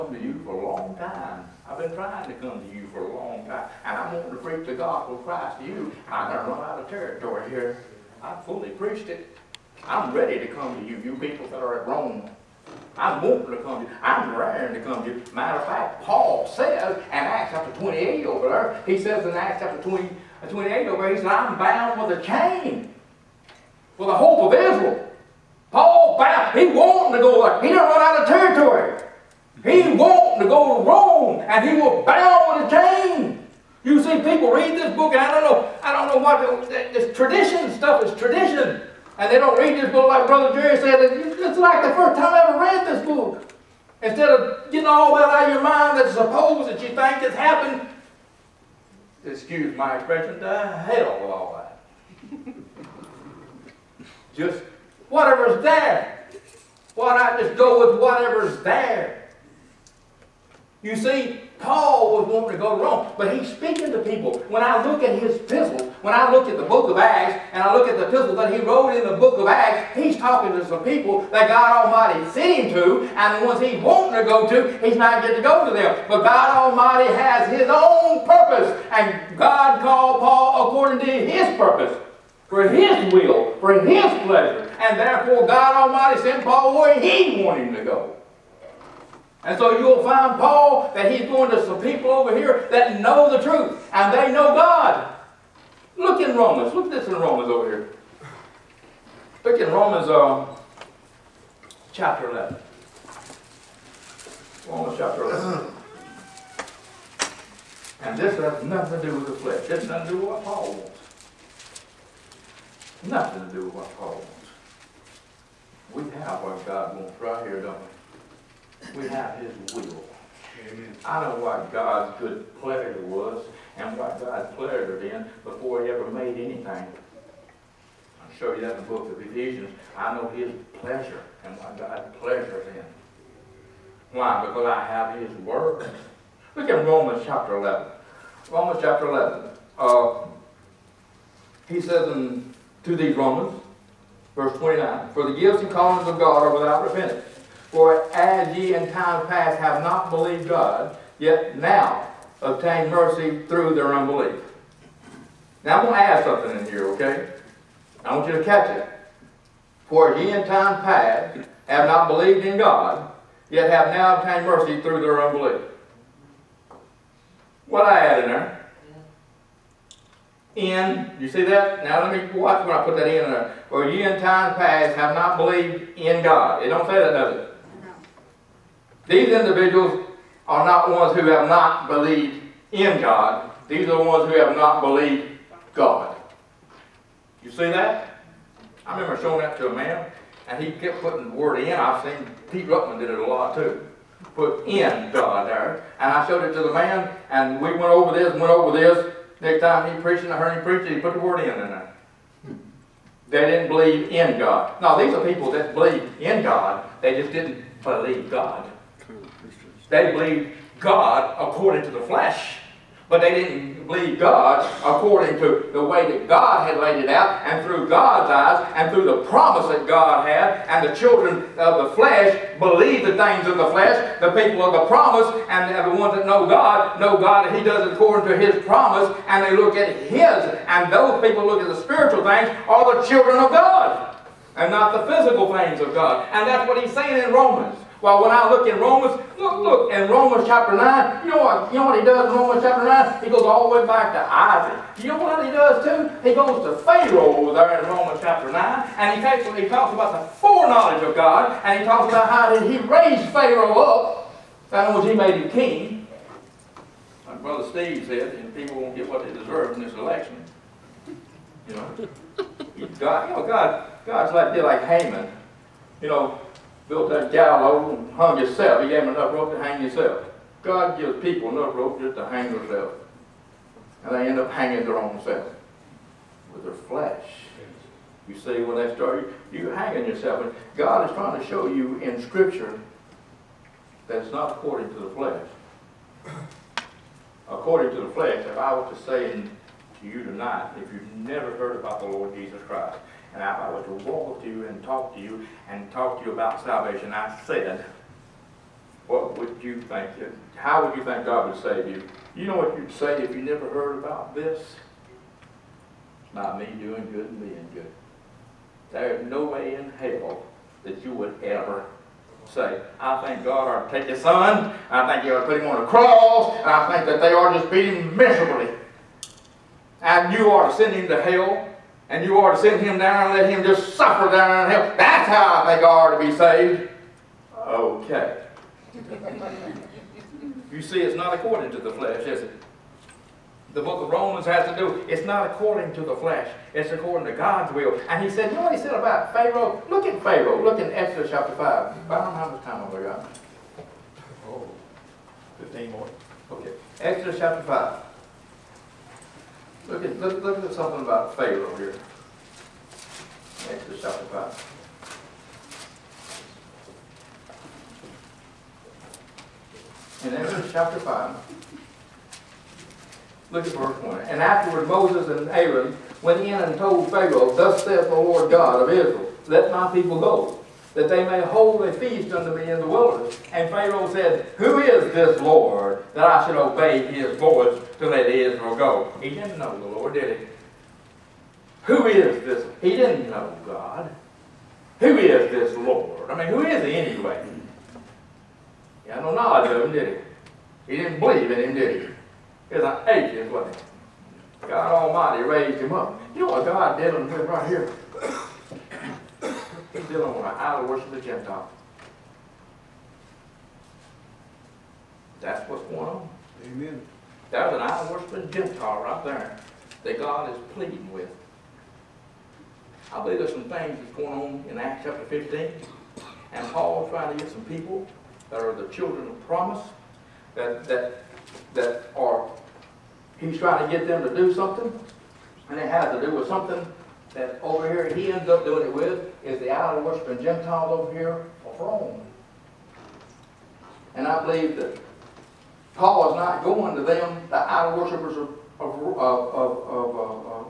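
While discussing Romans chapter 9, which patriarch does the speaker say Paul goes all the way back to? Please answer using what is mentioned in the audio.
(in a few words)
Isaac.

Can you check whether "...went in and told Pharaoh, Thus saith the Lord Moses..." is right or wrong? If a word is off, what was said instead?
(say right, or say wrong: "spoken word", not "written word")
wrong: "God", not "Moses".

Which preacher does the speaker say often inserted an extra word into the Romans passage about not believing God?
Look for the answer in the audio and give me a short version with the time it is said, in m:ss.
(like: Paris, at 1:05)
Pete Ruckman, at 3:12.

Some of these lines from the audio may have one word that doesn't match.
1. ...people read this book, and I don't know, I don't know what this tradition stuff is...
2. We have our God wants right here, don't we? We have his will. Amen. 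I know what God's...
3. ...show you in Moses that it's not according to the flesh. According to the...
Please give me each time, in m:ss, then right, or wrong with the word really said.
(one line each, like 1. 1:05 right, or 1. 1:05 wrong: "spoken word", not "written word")
1. 0:34 right
2. 1:55 right
3. 4:41 wrong: "Scripture", not "Moses".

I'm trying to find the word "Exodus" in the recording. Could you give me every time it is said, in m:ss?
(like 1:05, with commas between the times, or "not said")
5:40, 5:47, 5:53, 6:00.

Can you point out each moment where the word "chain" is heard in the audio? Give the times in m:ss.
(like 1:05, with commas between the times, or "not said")
0:22, 0:32.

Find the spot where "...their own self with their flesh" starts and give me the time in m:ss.
4:34.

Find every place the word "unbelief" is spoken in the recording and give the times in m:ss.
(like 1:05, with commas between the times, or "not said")
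2:33, 2:45.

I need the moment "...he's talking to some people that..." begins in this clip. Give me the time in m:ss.
1:09.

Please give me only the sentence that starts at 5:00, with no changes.
How would you think God would save you?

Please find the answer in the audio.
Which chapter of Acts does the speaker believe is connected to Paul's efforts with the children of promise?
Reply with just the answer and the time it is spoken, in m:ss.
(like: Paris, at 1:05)
Acts chapter 15, at 6:54.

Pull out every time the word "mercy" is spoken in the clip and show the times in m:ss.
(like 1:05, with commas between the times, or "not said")
2:32, 2:44.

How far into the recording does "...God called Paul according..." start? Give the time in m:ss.
1:19.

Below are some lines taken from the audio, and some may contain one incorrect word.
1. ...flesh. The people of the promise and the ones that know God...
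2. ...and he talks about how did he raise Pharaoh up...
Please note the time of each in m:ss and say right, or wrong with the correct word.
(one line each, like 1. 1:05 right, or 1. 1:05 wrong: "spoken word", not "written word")
1. 3:43 right
2. 4:11 right.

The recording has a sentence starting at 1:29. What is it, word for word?
And so you'll find Paul that he's going to some people over here that know the truth and they know God.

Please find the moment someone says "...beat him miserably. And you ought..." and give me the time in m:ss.
5:17.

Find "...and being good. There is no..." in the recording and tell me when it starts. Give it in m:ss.
5:07.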